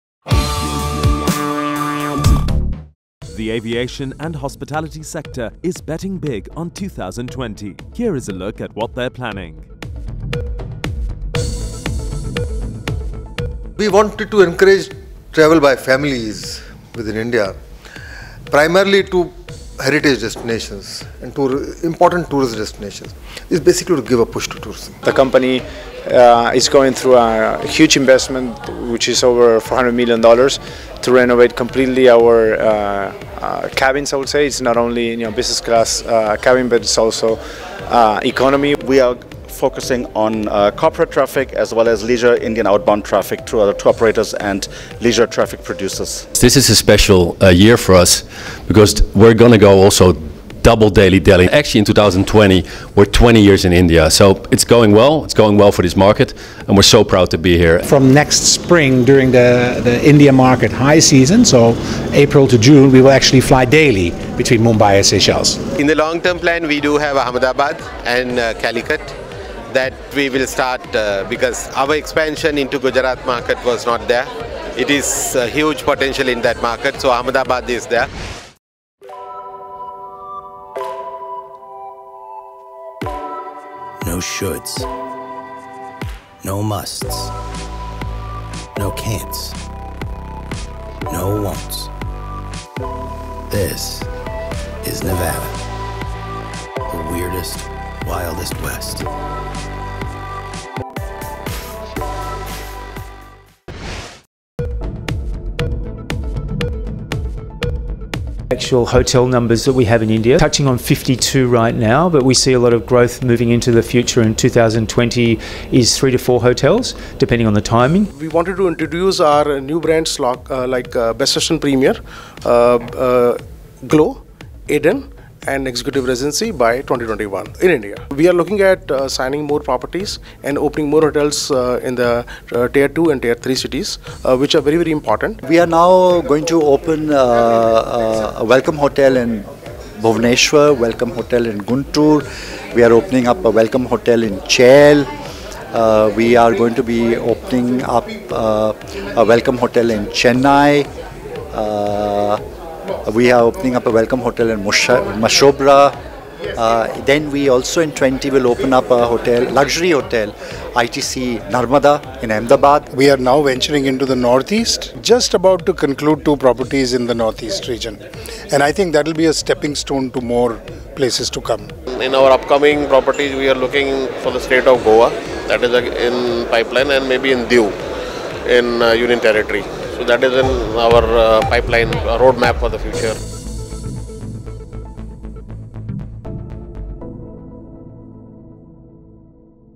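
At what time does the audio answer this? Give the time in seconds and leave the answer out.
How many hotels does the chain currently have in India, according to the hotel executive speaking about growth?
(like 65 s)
110 s.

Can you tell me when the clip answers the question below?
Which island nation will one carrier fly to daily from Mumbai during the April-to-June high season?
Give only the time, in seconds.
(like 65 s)
65 s.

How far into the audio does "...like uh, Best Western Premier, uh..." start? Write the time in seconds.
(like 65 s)
120 s.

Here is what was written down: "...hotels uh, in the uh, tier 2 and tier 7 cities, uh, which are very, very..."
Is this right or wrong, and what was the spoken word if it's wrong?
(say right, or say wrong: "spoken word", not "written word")
wrong: "3", not "7".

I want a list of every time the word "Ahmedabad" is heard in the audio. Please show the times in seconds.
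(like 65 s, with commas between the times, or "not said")
67 s, 77 s, 162 s.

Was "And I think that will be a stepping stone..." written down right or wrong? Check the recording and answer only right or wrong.
right.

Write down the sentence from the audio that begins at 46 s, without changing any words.
This is a special uh, year for us because we're going to go also double daily Delhi.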